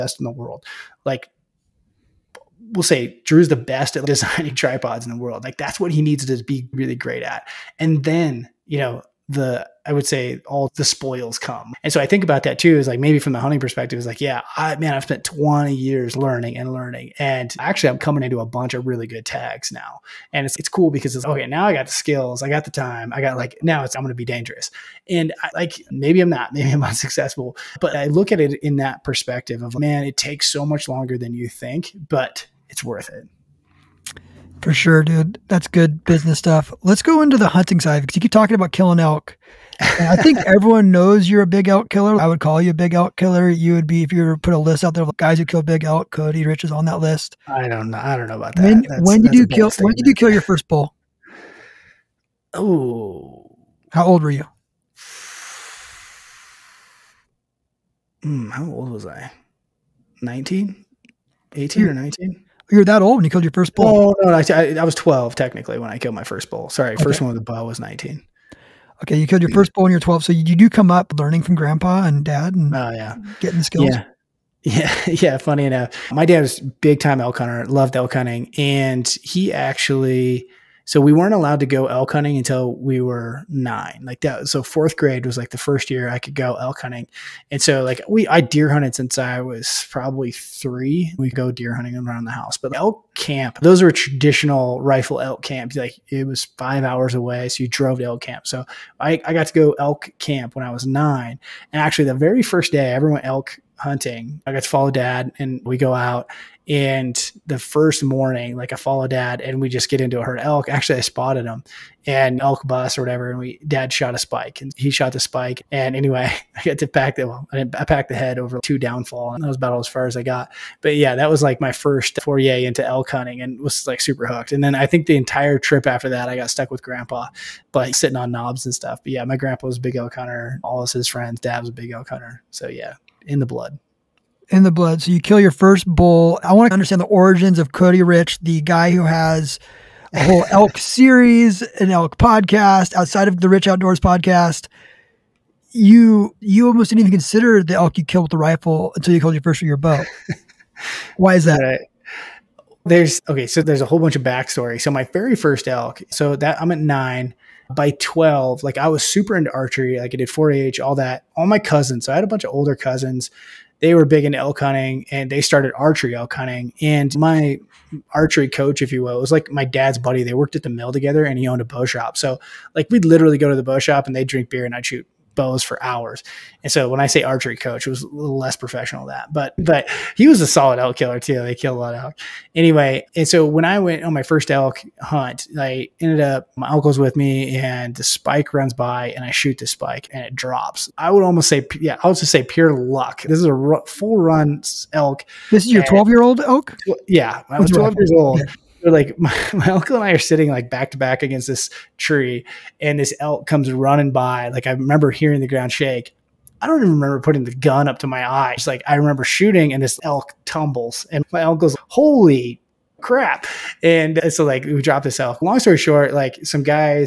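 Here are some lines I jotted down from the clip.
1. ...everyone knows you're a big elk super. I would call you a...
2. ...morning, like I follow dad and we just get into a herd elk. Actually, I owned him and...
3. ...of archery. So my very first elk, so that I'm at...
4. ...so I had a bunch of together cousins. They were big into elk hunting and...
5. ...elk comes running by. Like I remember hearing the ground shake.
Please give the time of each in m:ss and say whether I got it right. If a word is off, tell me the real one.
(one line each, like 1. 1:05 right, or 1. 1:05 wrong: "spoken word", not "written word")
1. 0:40 wrong: "killer", not "super"
2. 1:48 wrong: "spotted", not "owned"
3. 2:34 wrong: "backstory", not "archery"
4. 2:42 wrong: "older", not "together"
5. 3:23 right.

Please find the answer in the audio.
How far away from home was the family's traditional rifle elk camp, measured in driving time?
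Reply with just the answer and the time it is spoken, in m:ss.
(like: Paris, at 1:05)
5 hours, at 1:36.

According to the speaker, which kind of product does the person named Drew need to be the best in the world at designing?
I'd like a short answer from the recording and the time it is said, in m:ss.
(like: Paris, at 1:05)
Tripods, at 0:04.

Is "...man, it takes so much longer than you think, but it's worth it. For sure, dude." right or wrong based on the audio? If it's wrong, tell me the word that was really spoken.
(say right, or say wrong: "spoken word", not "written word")
right.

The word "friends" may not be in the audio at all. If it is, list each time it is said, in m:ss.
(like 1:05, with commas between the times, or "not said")
2:11.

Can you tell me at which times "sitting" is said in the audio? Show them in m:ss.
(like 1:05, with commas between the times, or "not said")
2:07, 3:20.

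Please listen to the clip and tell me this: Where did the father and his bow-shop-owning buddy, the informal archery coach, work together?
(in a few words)
The mill.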